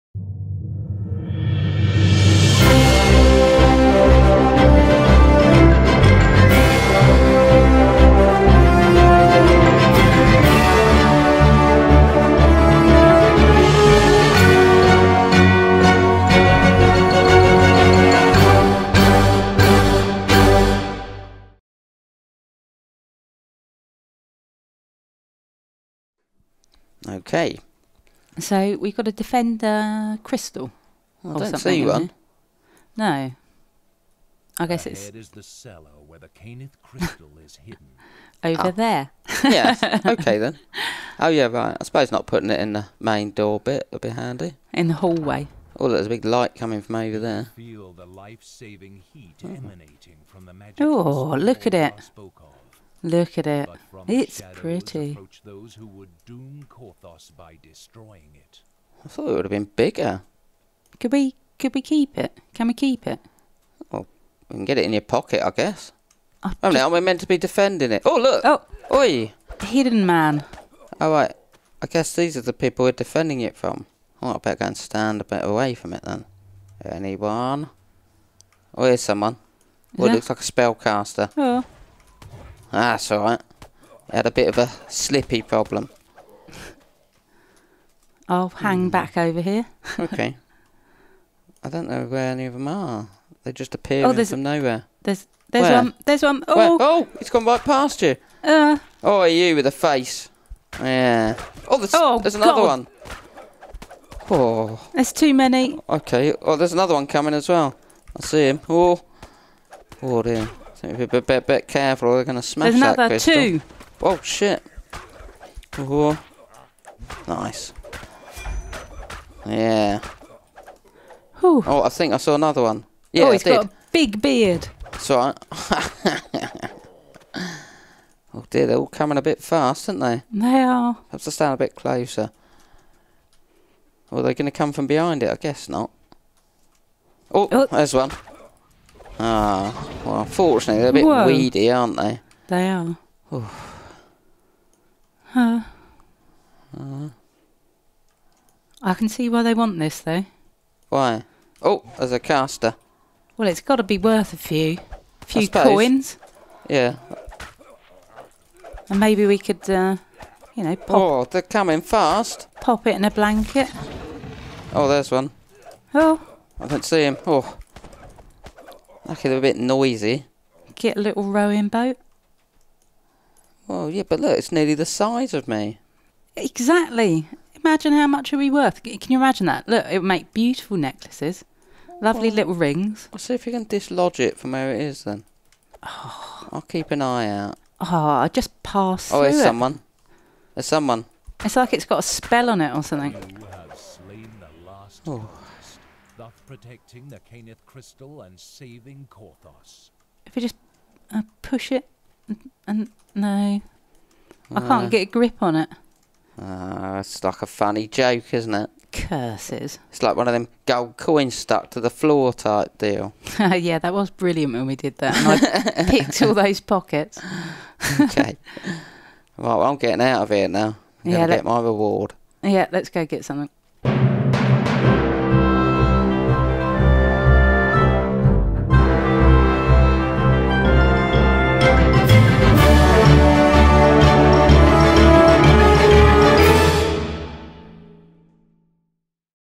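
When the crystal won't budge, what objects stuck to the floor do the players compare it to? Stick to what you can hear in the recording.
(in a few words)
Gold coins.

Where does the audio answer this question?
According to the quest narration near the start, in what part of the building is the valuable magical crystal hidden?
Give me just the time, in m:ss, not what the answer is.
0:35.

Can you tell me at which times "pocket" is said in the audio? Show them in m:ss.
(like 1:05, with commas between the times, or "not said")
1:05, 3:36.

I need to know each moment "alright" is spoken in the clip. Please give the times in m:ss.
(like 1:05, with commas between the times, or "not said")
1:10, 1:23.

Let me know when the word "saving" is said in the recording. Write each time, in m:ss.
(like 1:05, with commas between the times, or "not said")
0:48, 3:18.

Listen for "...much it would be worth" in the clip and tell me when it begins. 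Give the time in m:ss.
2:58.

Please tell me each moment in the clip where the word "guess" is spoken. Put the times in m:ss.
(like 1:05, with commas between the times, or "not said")
0:34, 1:05, 1:11, 2:15.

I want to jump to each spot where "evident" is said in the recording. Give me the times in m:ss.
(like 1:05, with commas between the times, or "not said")
not said.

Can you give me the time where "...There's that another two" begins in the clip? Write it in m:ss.
1:52.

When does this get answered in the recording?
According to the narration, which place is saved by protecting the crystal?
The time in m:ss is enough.
3:19.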